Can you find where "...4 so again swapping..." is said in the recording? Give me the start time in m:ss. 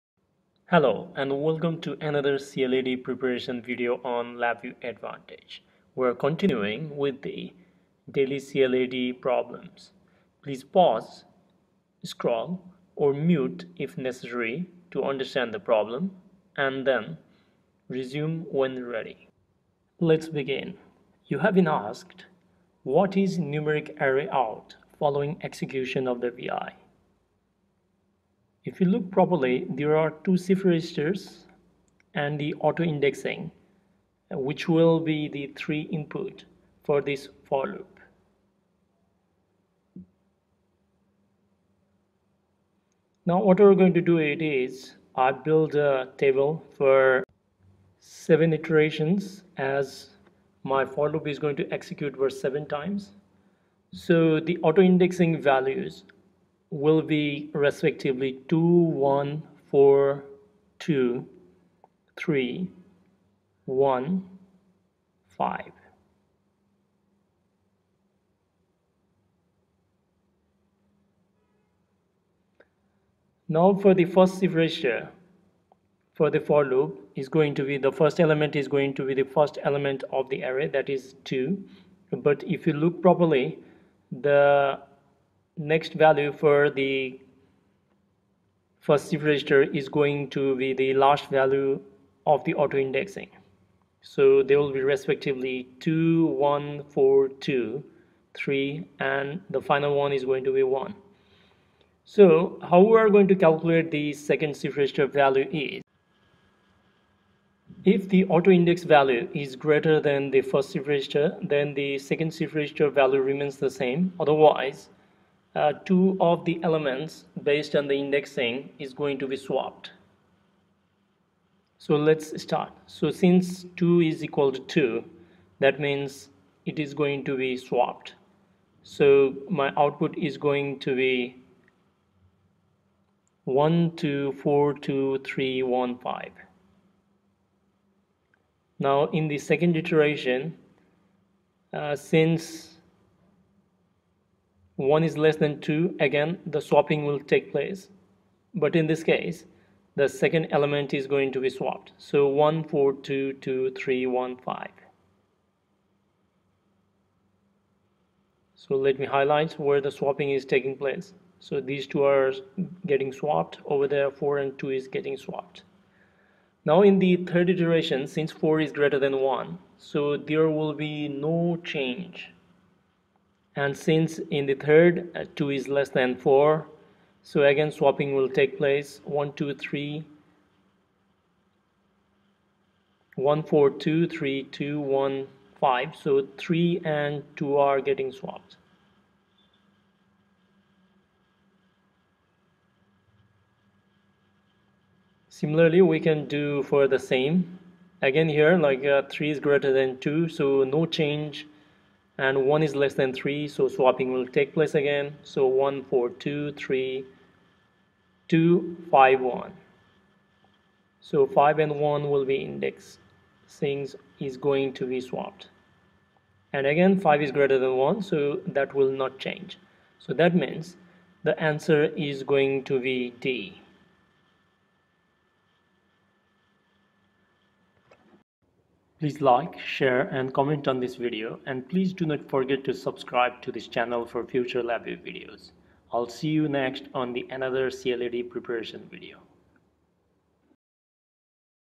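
2:56.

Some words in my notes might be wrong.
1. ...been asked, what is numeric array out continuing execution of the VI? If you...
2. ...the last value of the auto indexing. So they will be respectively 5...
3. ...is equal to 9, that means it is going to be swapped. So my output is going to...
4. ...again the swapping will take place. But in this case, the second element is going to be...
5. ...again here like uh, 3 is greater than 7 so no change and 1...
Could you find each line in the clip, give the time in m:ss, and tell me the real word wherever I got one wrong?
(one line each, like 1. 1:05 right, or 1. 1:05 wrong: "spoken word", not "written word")
1. 0:21 wrong: "following", not "continuing"
2. 1:30 wrong: "2", not "5"
3. 2:04 wrong: "2", not "9"
4. 2:25 right
5. 3:18 wrong: "2", not "7".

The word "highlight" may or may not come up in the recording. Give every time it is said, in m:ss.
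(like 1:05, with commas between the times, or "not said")
2:39.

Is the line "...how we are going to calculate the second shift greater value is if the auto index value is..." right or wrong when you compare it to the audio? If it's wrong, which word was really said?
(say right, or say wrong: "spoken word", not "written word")
wrong: "register", not "greater".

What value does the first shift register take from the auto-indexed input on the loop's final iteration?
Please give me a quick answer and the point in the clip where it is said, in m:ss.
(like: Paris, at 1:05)
1, at 1:39.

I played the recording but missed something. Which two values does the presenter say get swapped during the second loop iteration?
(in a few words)
4 and 2.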